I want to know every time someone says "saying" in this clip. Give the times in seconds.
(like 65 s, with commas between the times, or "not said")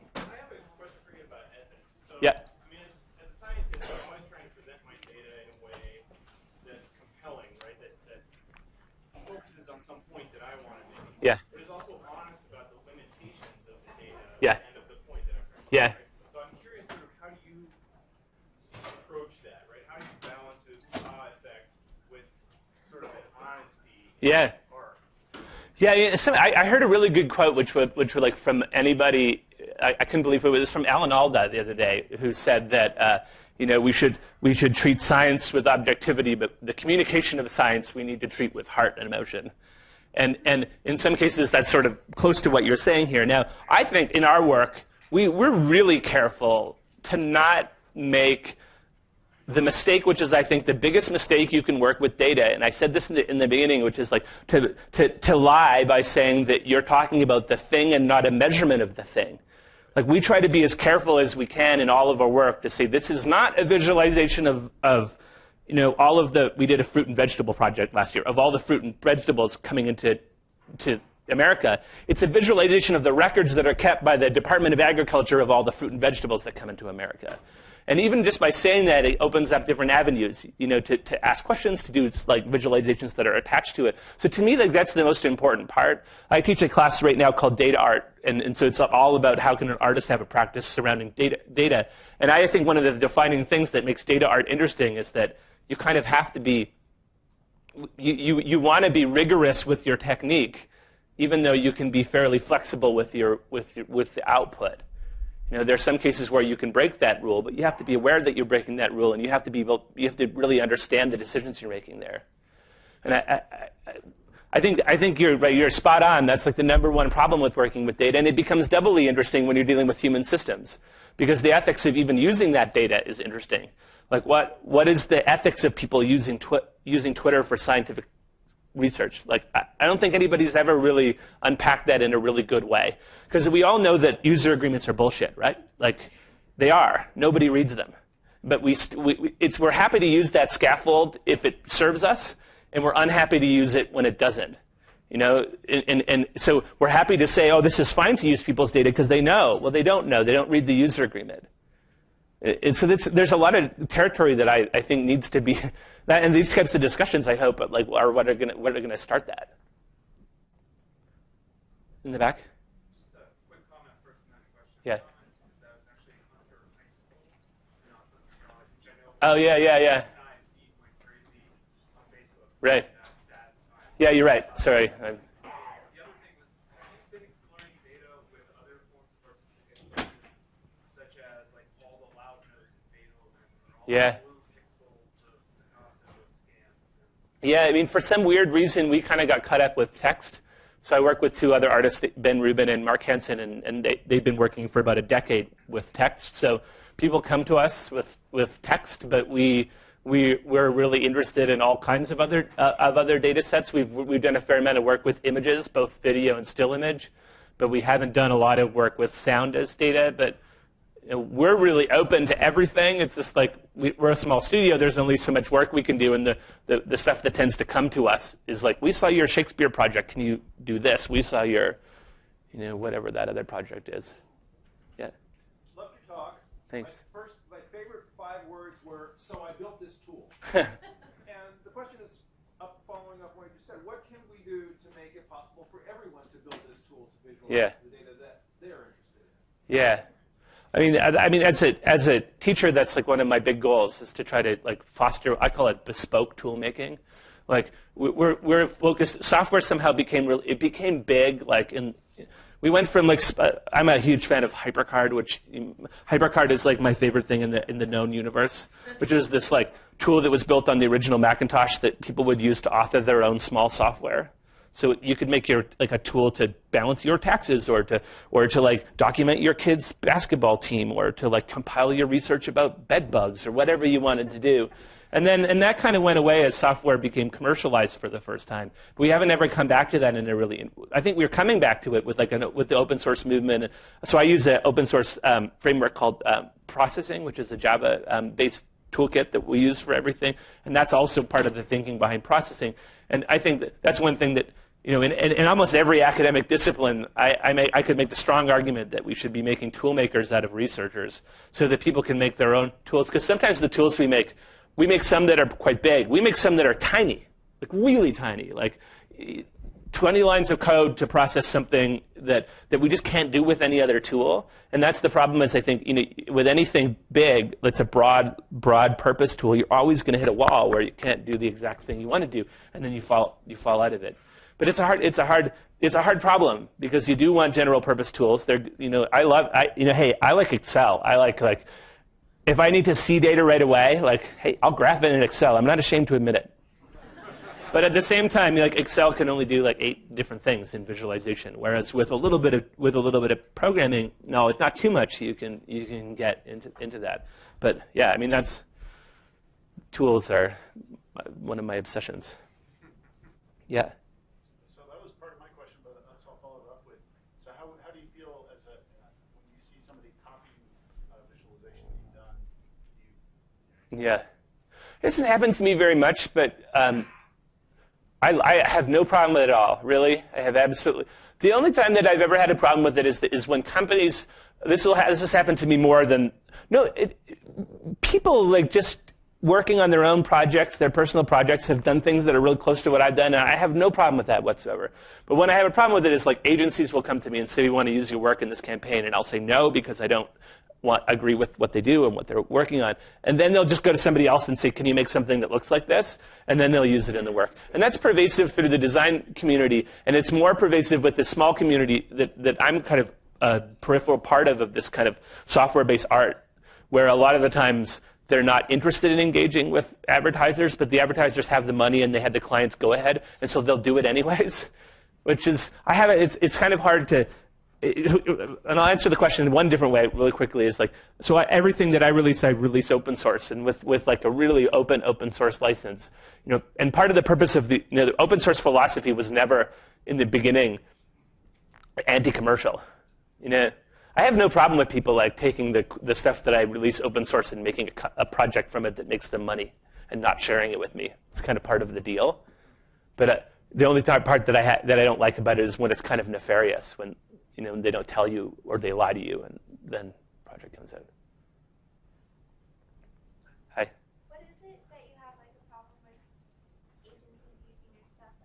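42 s, 56 s, 78 s.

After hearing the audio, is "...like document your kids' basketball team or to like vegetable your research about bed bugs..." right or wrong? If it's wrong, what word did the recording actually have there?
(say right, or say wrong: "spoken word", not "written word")
wrong: "compile", not "vegetable".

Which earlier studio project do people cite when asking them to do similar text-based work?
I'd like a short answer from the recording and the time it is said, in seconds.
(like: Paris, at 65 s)
Shakespeare project, at 219 s.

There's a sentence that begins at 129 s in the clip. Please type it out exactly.
Like, I don't think anybody's ever really unpacked that in a really good way.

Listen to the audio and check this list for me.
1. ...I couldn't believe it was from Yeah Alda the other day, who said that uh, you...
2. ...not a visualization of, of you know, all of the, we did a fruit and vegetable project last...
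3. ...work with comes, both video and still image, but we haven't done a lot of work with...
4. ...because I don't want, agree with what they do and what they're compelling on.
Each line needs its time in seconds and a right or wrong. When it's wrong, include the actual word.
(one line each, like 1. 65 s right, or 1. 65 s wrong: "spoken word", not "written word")
1. 29 s wrong: "Alan", not "Yeah"
2. 63 s right
3. 204 s wrong: "images", not "comes"
4. 389 s wrong: "working", not "compelling".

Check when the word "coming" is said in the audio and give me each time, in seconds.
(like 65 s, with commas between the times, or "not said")
69 s, 281 s.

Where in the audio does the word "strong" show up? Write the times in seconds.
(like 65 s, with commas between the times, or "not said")
298 s.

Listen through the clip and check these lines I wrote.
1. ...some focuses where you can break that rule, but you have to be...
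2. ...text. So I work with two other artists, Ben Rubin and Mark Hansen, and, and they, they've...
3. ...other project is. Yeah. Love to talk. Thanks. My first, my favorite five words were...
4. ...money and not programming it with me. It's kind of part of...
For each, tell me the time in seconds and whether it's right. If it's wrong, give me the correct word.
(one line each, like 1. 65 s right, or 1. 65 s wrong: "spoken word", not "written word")
1. 105 s wrong: "cases", not "focuses"
2. 189 s right
3. 223 s right
4. 439 s wrong: "sharing", not "programming".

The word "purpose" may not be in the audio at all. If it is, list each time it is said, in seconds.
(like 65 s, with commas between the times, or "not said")
318 s, 327 s, 427 s.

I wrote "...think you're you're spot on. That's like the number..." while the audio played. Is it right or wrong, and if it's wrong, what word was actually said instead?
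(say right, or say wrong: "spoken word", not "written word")
right.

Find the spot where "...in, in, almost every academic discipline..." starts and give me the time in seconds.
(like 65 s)
295 s.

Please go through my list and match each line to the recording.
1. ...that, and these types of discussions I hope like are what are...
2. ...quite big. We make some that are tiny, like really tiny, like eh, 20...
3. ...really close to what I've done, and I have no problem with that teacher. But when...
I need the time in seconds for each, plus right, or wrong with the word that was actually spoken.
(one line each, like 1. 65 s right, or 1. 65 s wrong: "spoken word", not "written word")
1. 156 s right
2. 305 s right
3. 382 s wrong: "whatsoever", not "teacher".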